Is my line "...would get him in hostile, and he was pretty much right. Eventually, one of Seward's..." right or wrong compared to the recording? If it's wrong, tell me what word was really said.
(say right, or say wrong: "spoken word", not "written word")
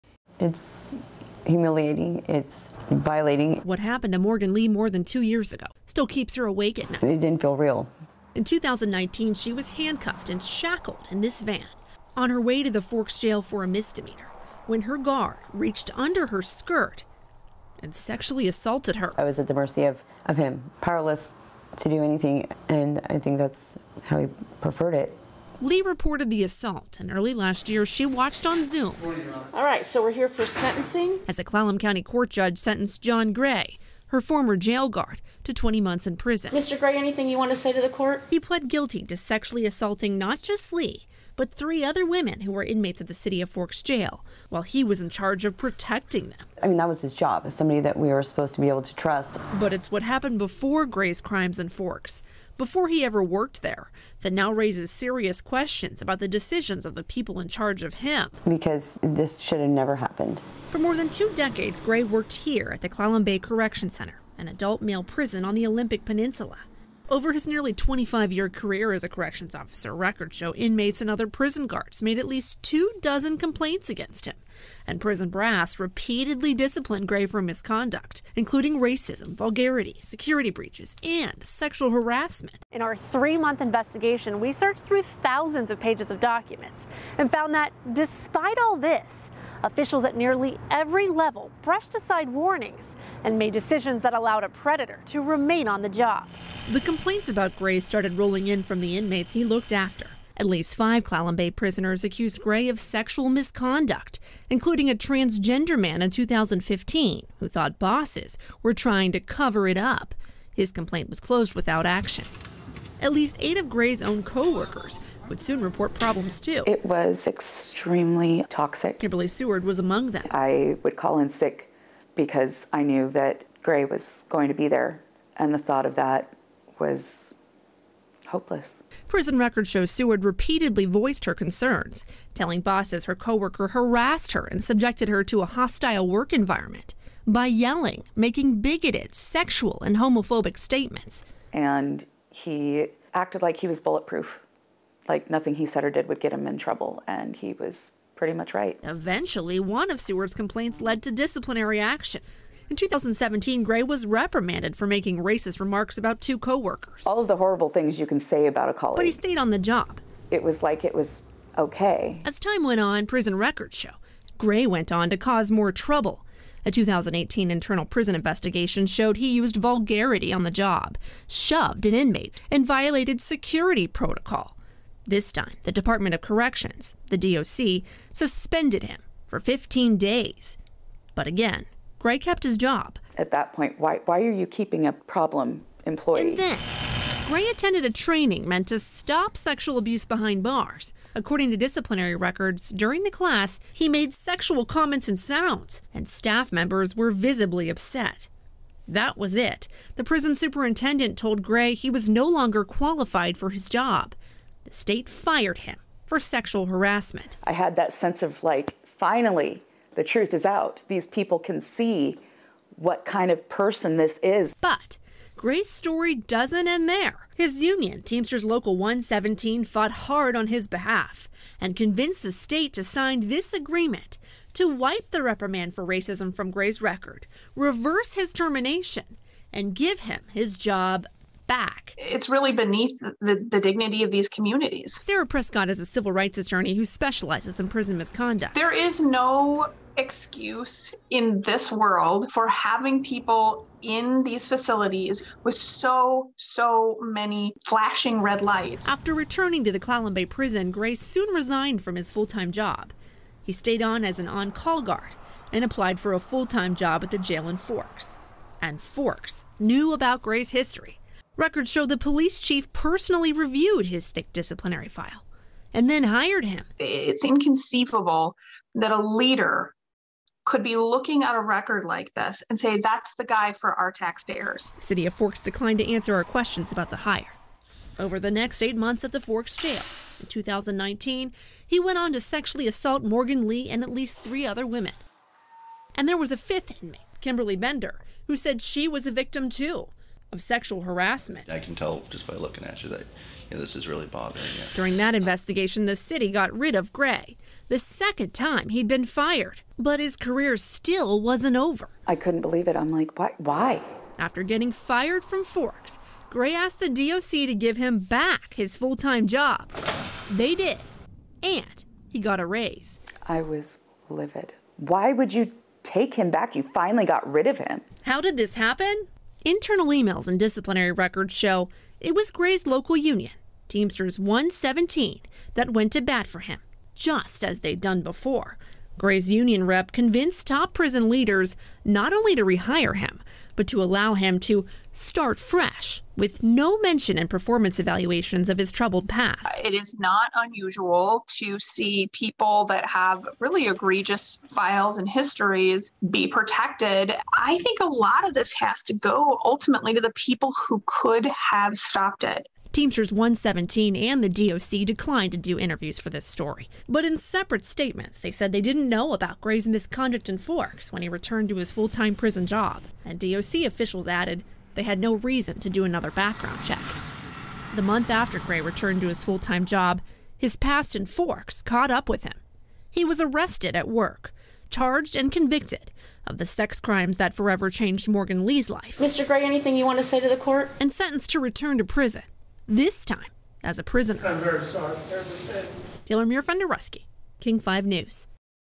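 wrong: "trouble", not "hostile".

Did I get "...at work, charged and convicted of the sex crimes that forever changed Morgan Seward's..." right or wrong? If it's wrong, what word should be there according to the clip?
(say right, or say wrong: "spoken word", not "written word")
wrong: "Lee", not "Seward".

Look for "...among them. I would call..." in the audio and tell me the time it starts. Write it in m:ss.
1:59.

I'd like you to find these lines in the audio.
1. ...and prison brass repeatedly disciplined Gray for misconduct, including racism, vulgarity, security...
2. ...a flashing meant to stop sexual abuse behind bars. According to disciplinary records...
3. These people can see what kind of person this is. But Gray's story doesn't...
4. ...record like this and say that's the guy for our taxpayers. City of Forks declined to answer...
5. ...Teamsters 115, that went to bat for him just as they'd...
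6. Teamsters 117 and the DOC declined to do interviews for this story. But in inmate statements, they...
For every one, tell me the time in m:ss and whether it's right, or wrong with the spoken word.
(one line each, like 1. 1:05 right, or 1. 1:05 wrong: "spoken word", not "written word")
1. 1:14 right
2. 3:07 wrong: "training", not "flashing"
3. 3:30 right
4. 4:31 right
5. 5:23 wrong: "117", not "115"
6. 5:52 wrong: "separate", not "inmate".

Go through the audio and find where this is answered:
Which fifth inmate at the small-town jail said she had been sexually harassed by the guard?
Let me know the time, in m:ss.
4:47.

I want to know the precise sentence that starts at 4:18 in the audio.
And Forks knew about Gray's history.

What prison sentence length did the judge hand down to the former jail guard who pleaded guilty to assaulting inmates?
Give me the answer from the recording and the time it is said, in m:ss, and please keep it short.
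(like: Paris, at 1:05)
20 months, at 0:35.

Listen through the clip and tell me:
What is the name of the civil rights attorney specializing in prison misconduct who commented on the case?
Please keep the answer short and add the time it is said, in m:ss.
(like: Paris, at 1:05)
Sarah Prescott, at 3:54.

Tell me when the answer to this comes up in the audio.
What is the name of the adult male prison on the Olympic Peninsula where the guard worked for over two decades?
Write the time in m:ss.
1:02.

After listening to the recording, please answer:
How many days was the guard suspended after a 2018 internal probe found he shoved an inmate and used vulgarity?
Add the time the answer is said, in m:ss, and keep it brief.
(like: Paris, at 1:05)
15, at 2:59.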